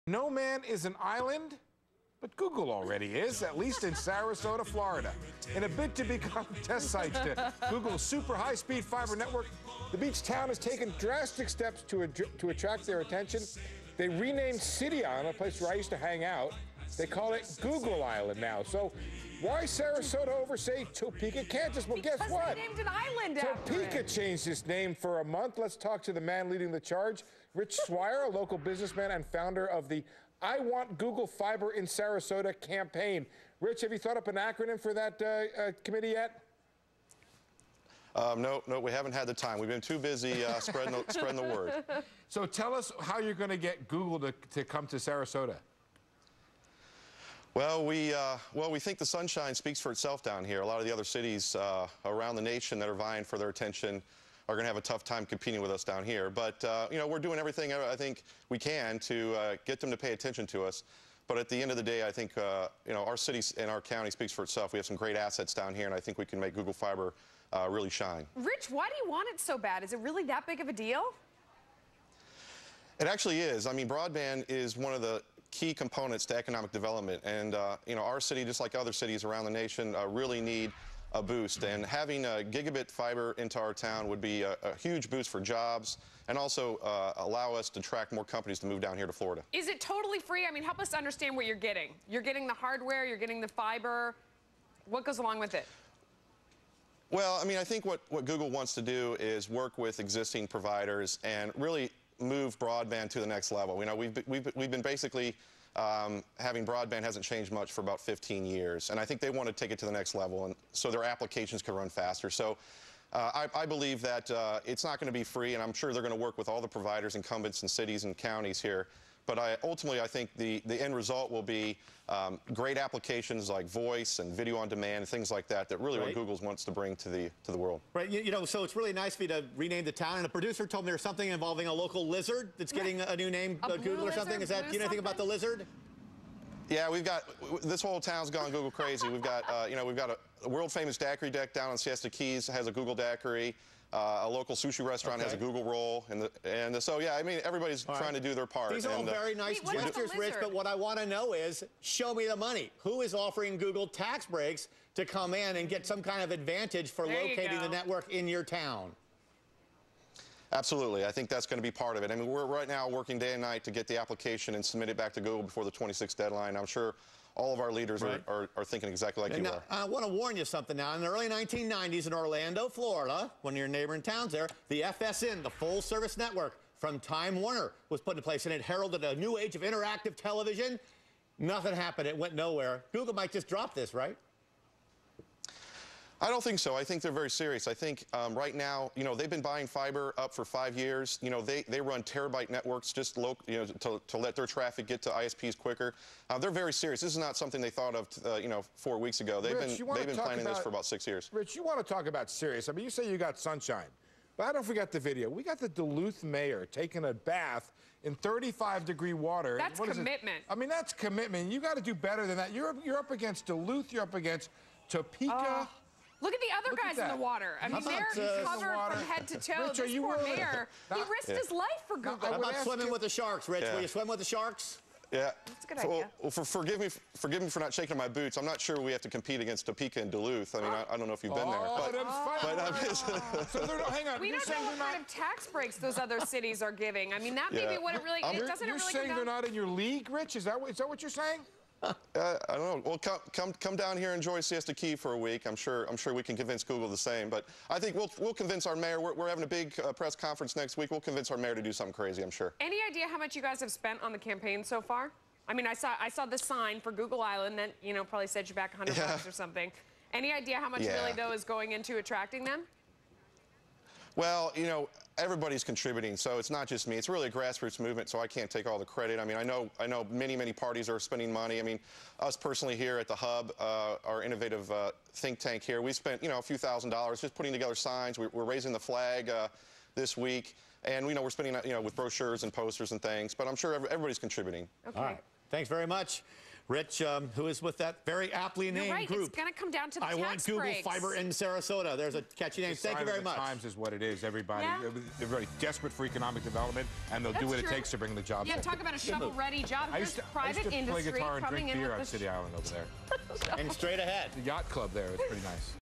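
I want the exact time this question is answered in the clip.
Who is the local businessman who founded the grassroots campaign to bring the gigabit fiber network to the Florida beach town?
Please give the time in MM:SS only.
00:27.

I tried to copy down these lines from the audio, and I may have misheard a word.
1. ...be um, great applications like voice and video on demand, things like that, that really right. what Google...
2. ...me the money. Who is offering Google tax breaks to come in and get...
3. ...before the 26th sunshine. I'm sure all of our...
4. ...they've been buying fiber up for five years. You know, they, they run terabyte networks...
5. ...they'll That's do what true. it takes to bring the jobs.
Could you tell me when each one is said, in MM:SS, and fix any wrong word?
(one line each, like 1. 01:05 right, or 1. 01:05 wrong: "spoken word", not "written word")
1. 02:01 right
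2. 02:32 right
3. 02:45 wrong: "deadline", not "sunshine"
4. 03:09 right
5. 04:57 right.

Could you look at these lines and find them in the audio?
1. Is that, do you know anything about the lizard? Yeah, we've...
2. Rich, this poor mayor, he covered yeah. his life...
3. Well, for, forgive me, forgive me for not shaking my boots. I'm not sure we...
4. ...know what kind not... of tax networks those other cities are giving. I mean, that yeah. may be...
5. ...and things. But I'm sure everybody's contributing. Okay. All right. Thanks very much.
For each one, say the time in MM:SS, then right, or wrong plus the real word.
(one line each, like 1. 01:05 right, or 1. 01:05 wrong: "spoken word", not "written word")
1. 02:14 right
2. 03:39 wrong: "risked", not "covered"
3. 03:46 right
4. 03:54 wrong: "breaks", not "networks"
5. 04:42 right.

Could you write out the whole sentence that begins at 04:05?
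I'm sure I'm sure we can convince Google the same.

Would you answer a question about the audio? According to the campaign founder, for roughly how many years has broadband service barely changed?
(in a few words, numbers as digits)
15 years.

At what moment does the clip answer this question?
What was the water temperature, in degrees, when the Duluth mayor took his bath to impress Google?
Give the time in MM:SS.
03:28.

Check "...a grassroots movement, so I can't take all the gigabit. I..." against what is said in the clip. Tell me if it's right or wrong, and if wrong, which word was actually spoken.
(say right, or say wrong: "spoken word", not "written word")
wrong: "credit", not "gigabit".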